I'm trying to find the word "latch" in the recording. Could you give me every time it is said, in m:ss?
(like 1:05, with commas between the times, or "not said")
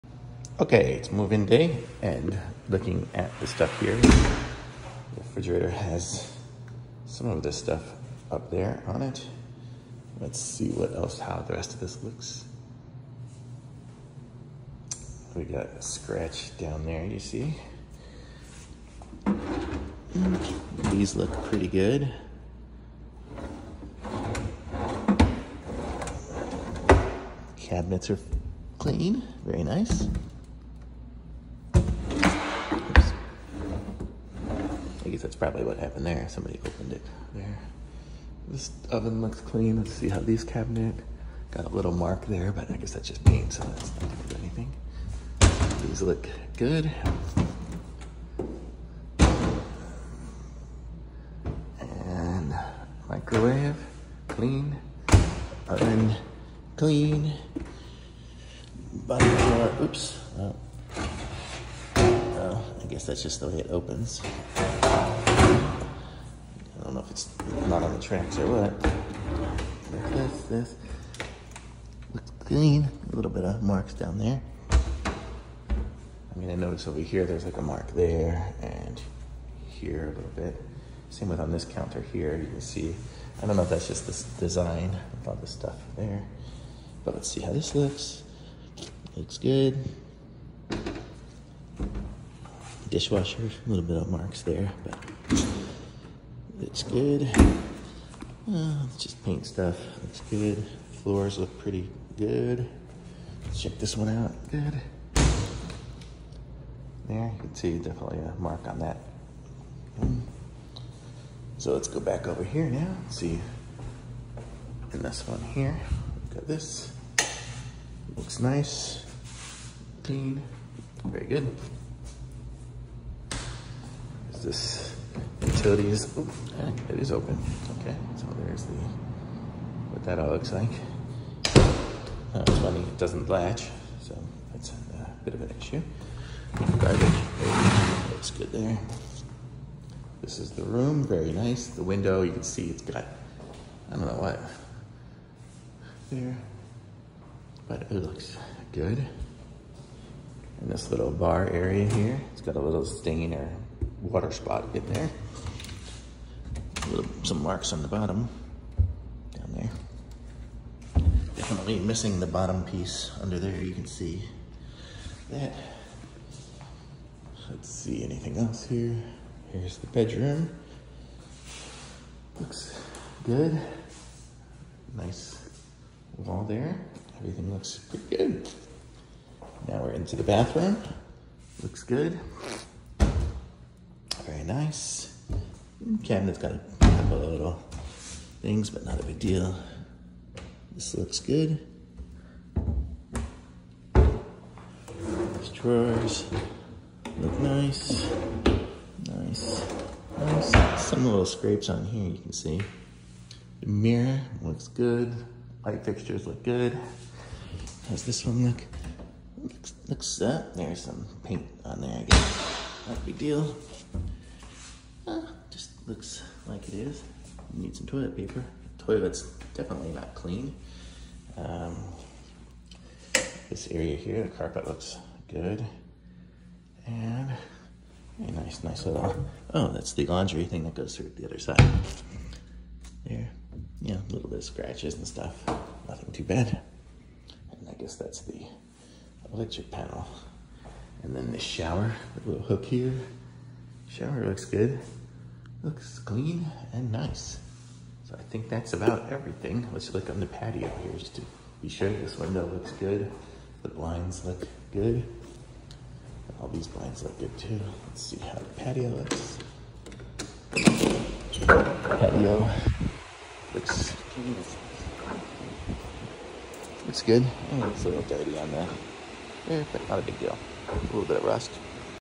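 2:13.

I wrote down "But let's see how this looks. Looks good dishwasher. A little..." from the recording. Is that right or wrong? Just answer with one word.
right.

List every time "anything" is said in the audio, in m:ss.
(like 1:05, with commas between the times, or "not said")
0:44, 2:48.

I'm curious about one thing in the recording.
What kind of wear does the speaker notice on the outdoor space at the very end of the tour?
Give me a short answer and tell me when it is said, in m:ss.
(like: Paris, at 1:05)
Rust, at 4:31.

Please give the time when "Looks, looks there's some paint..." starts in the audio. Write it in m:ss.
3:29.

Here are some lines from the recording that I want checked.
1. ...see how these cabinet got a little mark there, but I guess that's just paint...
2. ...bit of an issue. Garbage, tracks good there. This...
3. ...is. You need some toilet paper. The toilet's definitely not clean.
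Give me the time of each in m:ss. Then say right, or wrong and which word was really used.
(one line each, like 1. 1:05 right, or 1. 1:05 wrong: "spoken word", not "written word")
1. 0:39 right
2. 2:15 wrong: "looks", not "tracks"
3. 3:36 right.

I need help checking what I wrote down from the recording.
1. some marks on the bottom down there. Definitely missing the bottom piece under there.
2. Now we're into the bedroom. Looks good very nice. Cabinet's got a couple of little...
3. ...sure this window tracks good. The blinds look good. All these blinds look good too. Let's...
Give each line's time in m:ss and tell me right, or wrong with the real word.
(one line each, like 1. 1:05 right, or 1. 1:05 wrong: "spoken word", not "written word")
1. 2:37 right
2. 2:59 wrong: "bathroom", not "bedroom"
3. 4:11 wrong: "looks", not "tracks".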